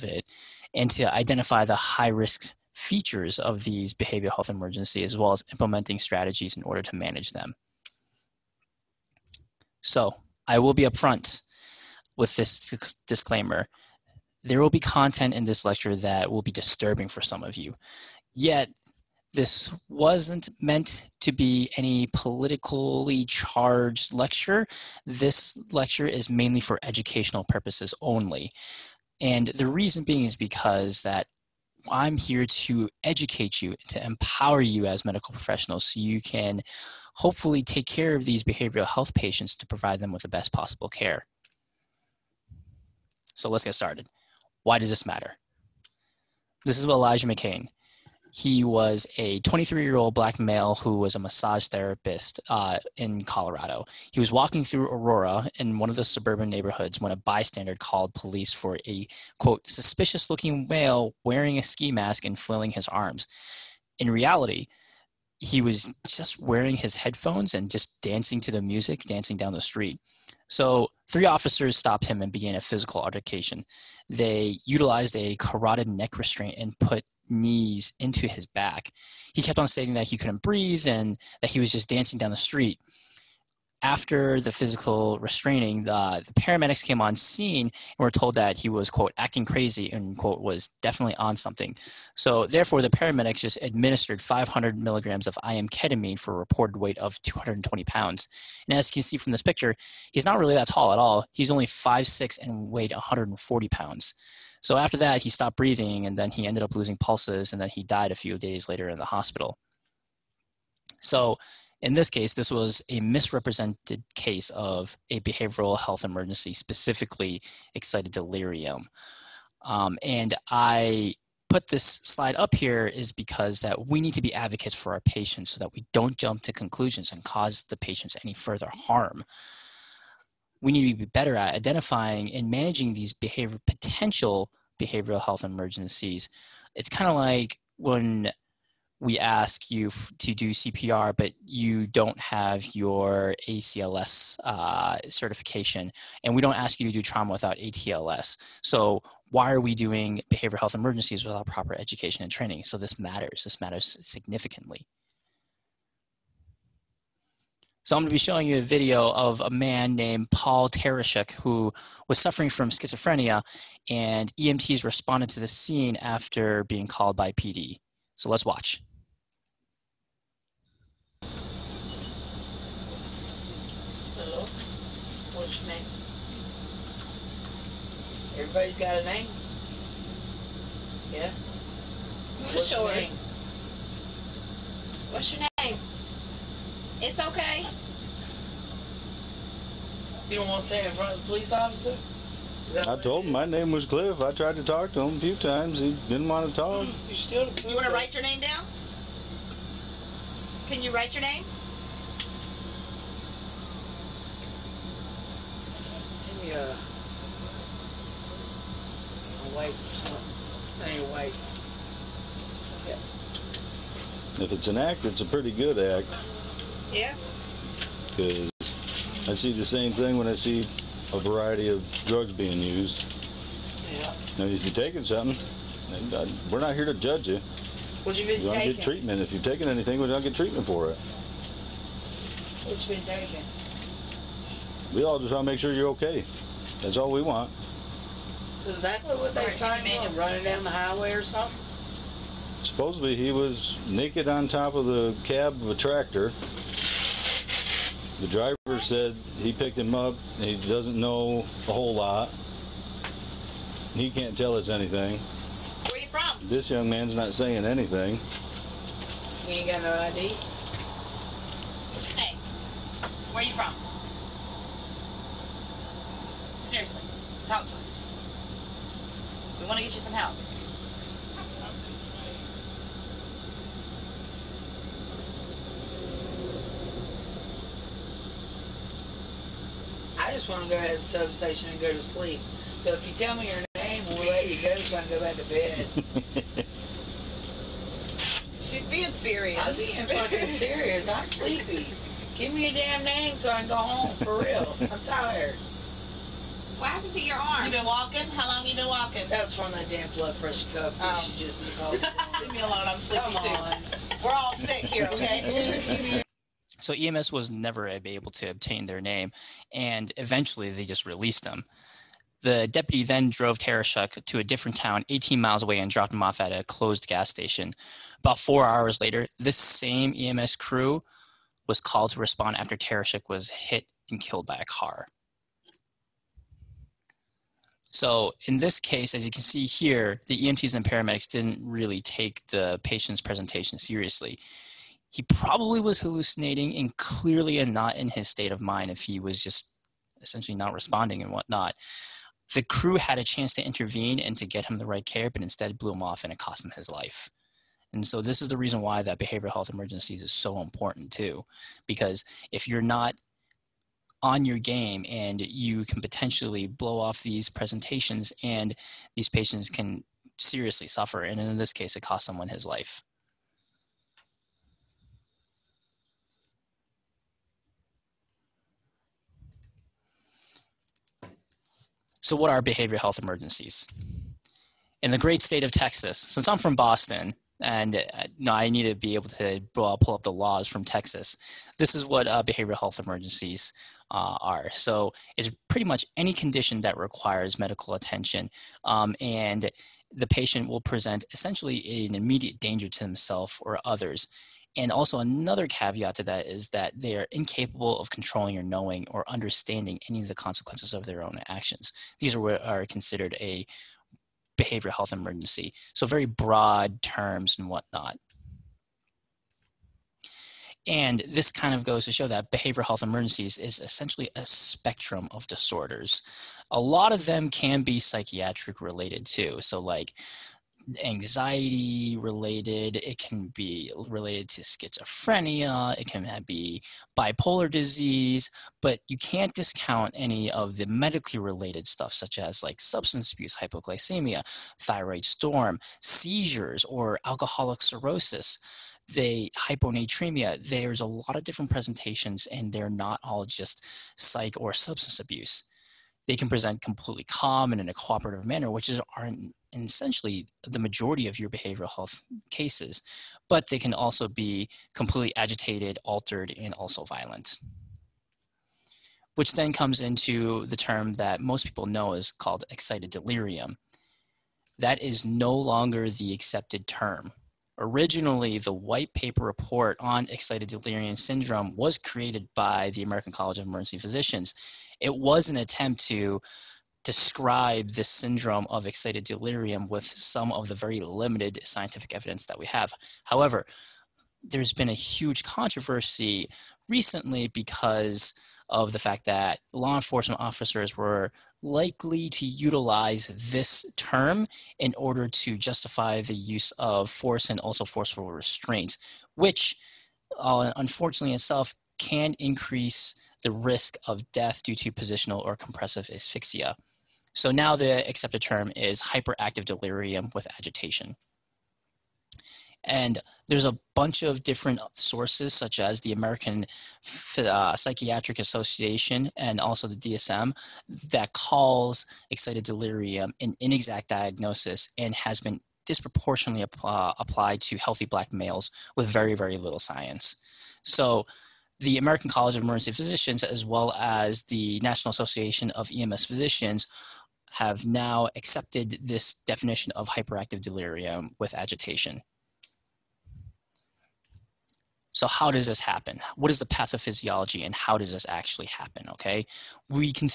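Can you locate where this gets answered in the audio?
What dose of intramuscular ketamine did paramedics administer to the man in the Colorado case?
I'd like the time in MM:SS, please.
01:34.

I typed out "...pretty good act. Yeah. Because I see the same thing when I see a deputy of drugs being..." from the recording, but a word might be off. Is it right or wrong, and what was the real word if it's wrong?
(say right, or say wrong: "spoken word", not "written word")
wrong: "variety", not "deputy".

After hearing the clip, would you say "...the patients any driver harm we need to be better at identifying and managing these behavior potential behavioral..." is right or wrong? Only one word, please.
wrong.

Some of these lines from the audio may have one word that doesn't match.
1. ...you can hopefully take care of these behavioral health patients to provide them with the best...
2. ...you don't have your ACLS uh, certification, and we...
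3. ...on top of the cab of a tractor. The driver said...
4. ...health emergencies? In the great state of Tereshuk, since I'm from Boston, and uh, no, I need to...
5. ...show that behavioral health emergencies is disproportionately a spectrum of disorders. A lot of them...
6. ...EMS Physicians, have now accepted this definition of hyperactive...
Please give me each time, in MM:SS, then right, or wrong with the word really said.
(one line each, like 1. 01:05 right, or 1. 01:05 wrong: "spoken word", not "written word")
1. 00:35 right
2. 02:21 right
3. 04:04 right
4. 06:12 wrong: "Texas", not "Tereshuk"
5. 06:52 wrong: "essentially", not "disproportionately"
6. 08:55 right.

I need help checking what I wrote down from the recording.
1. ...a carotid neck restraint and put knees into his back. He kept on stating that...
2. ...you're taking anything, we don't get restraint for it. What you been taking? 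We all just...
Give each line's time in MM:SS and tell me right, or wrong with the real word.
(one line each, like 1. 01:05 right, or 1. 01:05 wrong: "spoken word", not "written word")
1. 01:15 right
2. 03:49 wrong: "treatment", not "restraint".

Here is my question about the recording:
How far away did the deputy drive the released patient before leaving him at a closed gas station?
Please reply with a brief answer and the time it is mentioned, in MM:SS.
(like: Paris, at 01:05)
18 miles, at 05:15.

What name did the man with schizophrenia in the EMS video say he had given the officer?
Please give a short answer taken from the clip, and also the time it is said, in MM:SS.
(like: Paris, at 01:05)
Cliff, at 03:13.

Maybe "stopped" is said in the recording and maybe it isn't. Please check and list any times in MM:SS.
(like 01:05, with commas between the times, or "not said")
01:11, 01:45.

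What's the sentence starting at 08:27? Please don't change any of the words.
So now the accepted term is hyperactive delirium with agitation.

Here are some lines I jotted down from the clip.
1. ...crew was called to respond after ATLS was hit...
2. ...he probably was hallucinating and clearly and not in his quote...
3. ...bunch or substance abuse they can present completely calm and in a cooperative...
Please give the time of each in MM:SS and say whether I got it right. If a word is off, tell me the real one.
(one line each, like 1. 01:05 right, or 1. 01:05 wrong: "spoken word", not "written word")
1. 05:20 wrong: "Tereshuk", not "ATLS"
2. 05:35 wrong: "state", not "quote"
3. 07:24 wrong: "psych", not "bunch".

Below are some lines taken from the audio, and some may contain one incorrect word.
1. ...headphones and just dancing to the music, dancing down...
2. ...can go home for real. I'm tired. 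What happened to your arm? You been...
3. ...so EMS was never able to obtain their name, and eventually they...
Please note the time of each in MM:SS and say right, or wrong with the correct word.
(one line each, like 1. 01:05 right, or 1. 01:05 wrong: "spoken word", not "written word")
1. 01:06 right
2. 04:53 right
3. 05:06 right.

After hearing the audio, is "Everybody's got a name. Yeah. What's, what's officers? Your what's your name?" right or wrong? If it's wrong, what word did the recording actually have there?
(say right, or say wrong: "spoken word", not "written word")
wrong: "yours", not "officers".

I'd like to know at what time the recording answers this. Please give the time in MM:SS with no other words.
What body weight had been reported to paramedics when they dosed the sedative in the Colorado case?
01:37.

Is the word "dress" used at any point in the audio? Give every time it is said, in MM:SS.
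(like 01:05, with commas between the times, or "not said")
not said.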